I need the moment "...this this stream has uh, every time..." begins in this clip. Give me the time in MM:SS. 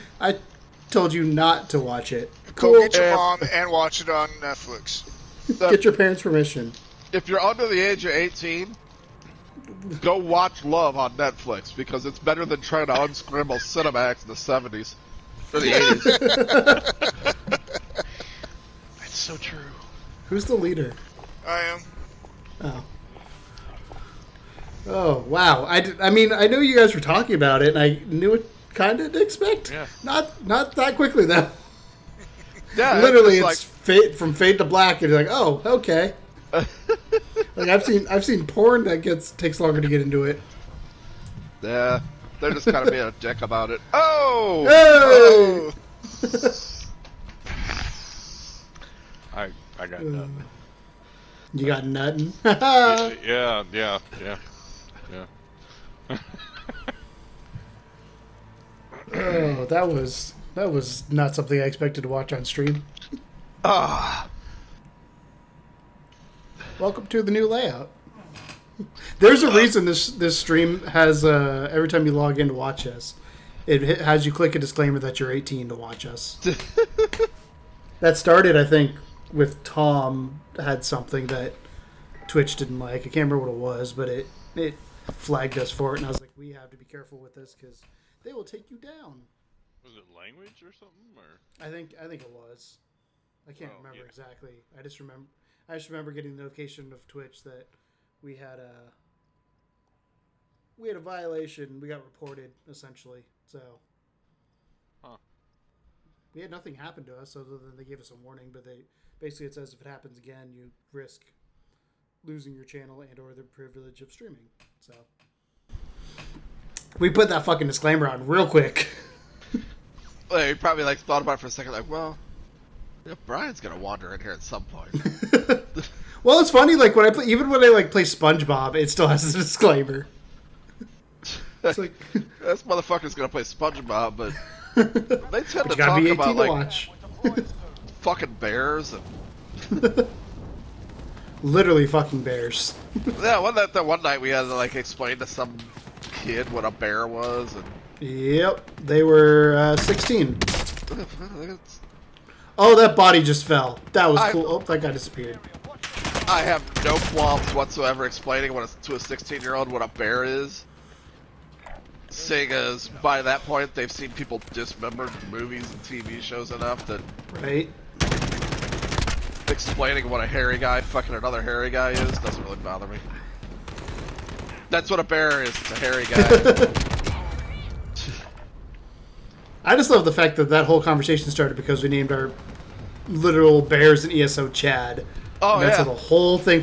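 01:09.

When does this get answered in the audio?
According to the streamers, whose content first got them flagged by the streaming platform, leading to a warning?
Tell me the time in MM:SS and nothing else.
01:19.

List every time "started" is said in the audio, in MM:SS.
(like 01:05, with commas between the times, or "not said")
01:18, 03:01.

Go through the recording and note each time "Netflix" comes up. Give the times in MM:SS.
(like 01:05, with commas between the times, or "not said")
00:04, 00:11.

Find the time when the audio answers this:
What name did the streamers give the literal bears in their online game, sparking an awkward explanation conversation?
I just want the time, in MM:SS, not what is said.
03:04.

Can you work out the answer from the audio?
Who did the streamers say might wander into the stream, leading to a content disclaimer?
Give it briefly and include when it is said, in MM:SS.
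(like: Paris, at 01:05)
Brian, at 02:03.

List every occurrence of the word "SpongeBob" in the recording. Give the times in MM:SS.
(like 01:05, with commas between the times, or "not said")
02:08, 02:13.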